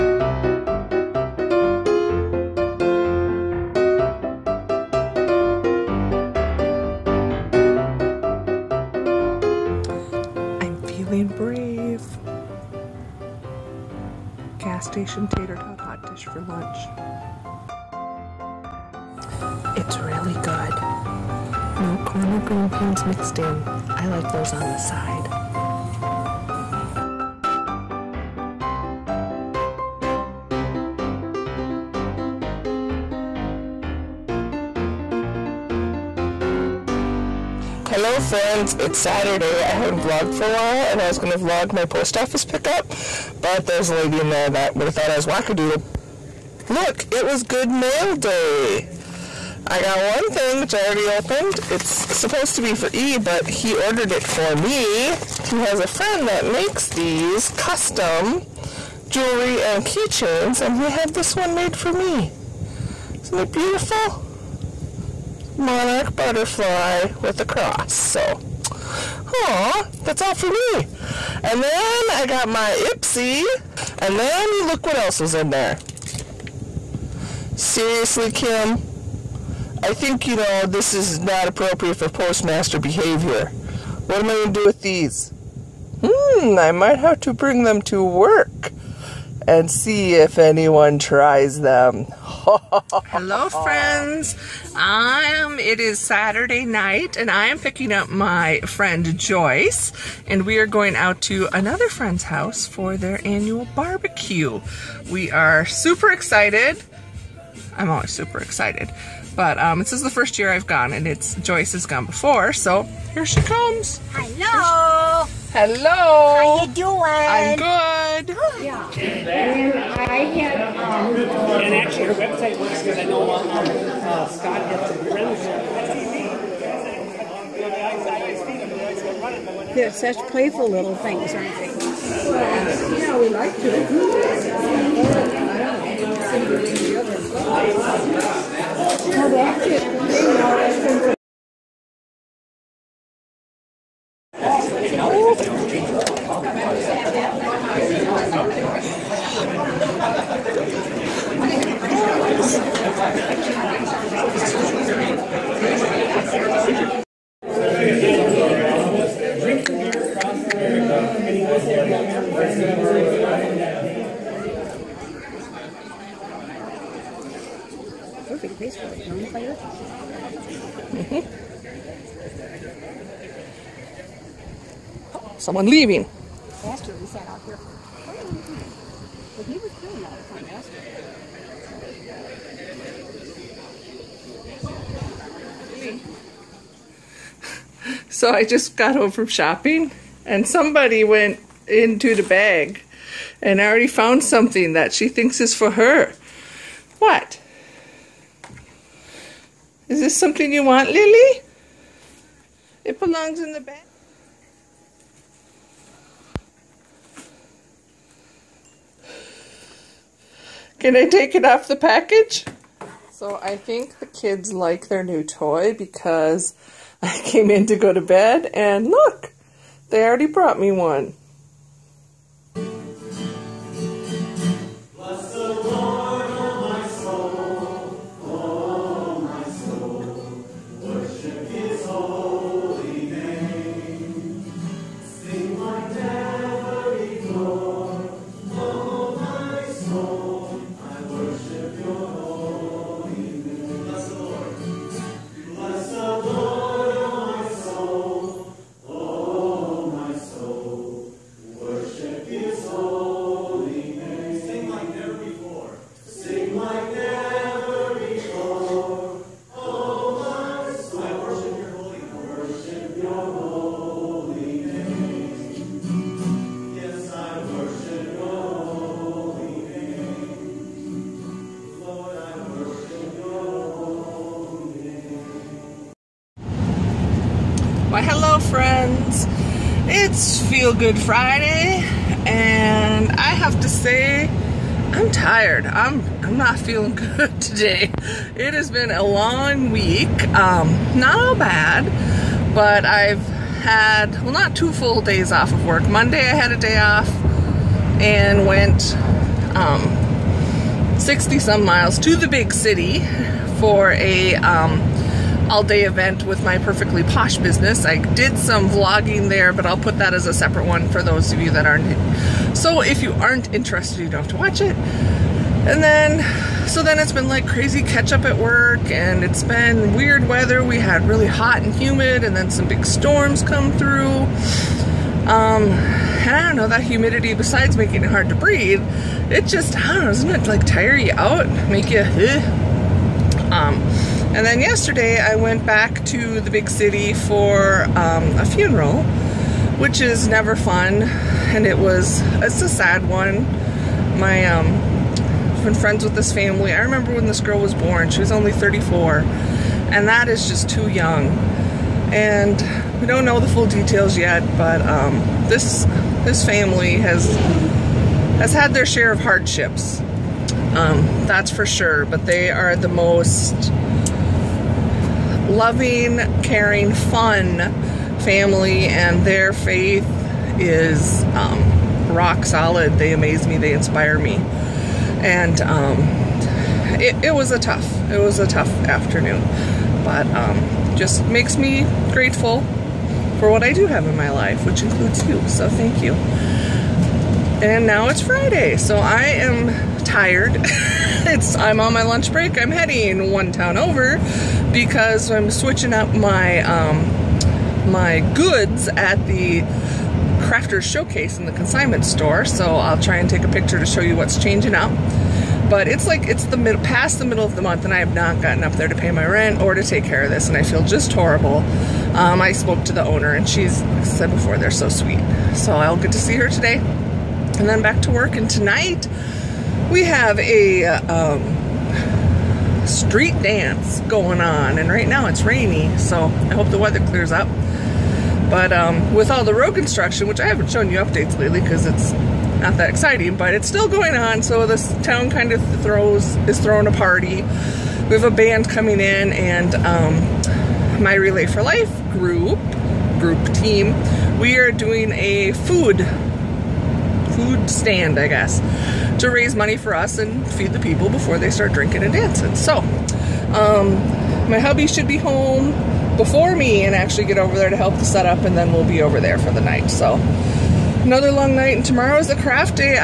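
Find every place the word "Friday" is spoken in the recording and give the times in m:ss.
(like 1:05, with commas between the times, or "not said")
4:40, 6:28.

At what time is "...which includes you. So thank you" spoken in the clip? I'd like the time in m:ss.
6:24.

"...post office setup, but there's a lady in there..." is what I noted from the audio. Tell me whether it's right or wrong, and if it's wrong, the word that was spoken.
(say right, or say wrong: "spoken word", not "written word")
wrong: "pickup", not "setup".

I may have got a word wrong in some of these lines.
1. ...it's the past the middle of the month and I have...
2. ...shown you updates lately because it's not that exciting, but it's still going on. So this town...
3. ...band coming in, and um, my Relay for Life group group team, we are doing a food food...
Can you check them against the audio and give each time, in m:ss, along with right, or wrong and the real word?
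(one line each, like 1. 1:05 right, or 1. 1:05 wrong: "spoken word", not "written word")
1. 6:46 right
2. 7:10 right
3. 7:18 right.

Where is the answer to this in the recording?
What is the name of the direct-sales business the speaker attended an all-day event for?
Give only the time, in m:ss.
5:06.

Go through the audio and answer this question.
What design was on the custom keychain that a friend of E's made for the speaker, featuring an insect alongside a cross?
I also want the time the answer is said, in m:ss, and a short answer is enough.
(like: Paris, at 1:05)
Monarch butterfly, at 1:05.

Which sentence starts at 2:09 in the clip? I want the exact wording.
They're such playful little things, aren't they?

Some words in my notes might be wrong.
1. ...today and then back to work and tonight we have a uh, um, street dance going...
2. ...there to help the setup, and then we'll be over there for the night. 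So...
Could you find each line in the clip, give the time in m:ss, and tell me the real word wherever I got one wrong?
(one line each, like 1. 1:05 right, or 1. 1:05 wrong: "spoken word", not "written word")
1. 6:56 right
2. 7:37 right.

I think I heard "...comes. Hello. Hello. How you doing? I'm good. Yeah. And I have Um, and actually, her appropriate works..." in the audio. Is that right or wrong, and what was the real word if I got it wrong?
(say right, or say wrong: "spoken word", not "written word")
wrong: "website", not "appropriate".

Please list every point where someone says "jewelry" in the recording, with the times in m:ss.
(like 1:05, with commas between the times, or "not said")
0:59.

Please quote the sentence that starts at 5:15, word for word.
And then, so then it's been like crazy catch up at work and it's been weird weather.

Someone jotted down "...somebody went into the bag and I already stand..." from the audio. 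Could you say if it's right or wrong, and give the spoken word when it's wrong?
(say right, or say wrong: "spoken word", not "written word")
wrong: "found", not "stand".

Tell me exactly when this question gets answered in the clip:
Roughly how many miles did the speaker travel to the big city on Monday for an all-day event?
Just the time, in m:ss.
5:00.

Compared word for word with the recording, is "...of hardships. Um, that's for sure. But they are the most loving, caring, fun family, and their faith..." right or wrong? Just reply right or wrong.
right.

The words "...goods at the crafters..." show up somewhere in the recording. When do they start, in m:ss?
6:38.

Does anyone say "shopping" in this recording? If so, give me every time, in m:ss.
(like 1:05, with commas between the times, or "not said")
3:09.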